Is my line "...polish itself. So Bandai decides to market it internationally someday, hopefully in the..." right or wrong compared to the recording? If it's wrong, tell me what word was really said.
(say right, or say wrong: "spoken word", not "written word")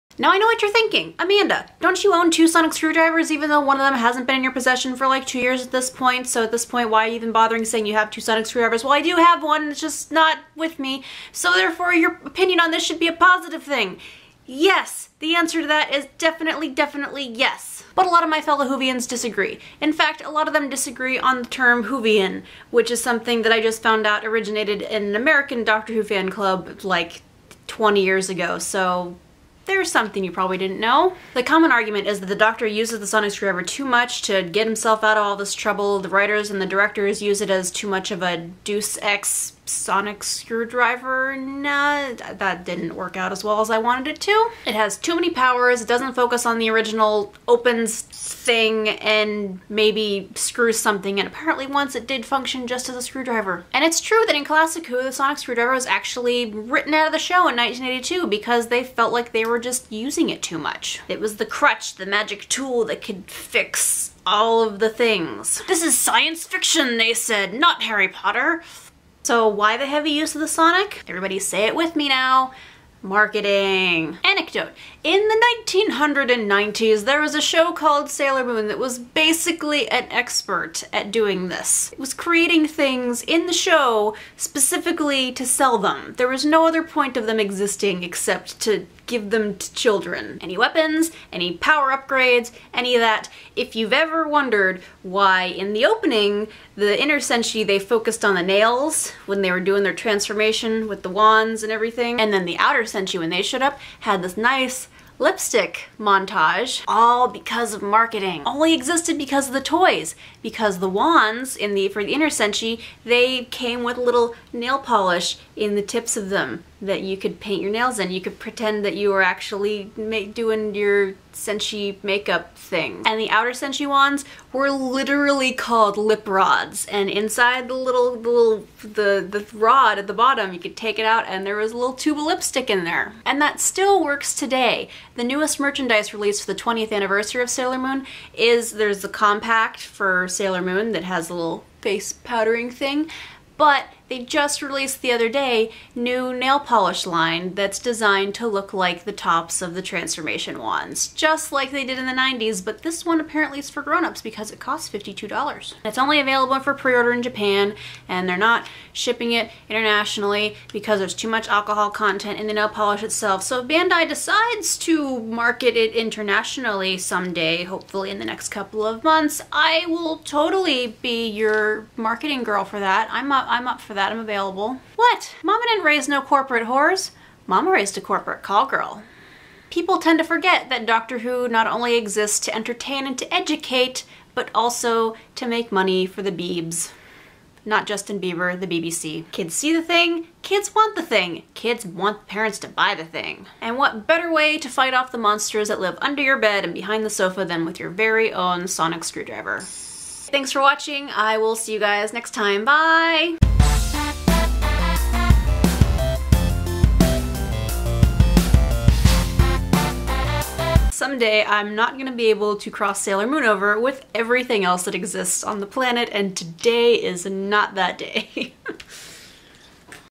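right.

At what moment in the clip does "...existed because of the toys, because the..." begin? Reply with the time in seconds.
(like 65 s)
108 s.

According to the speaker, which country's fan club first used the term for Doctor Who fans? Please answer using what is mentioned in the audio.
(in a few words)
American.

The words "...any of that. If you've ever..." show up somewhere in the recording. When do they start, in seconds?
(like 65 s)
92 s.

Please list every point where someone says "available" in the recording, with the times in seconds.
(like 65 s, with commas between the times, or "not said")
156 s, 174 s.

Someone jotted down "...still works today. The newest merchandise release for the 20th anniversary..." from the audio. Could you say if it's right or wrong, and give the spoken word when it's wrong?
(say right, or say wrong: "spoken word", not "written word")
right.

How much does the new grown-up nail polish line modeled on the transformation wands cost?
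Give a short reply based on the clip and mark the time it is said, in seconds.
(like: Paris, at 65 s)
$52, at 154 s.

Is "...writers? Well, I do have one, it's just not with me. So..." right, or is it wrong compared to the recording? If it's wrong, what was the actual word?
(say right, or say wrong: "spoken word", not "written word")
wrong: "screwdrivers", not "writers".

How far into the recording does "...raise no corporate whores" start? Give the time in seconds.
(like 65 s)
175 s.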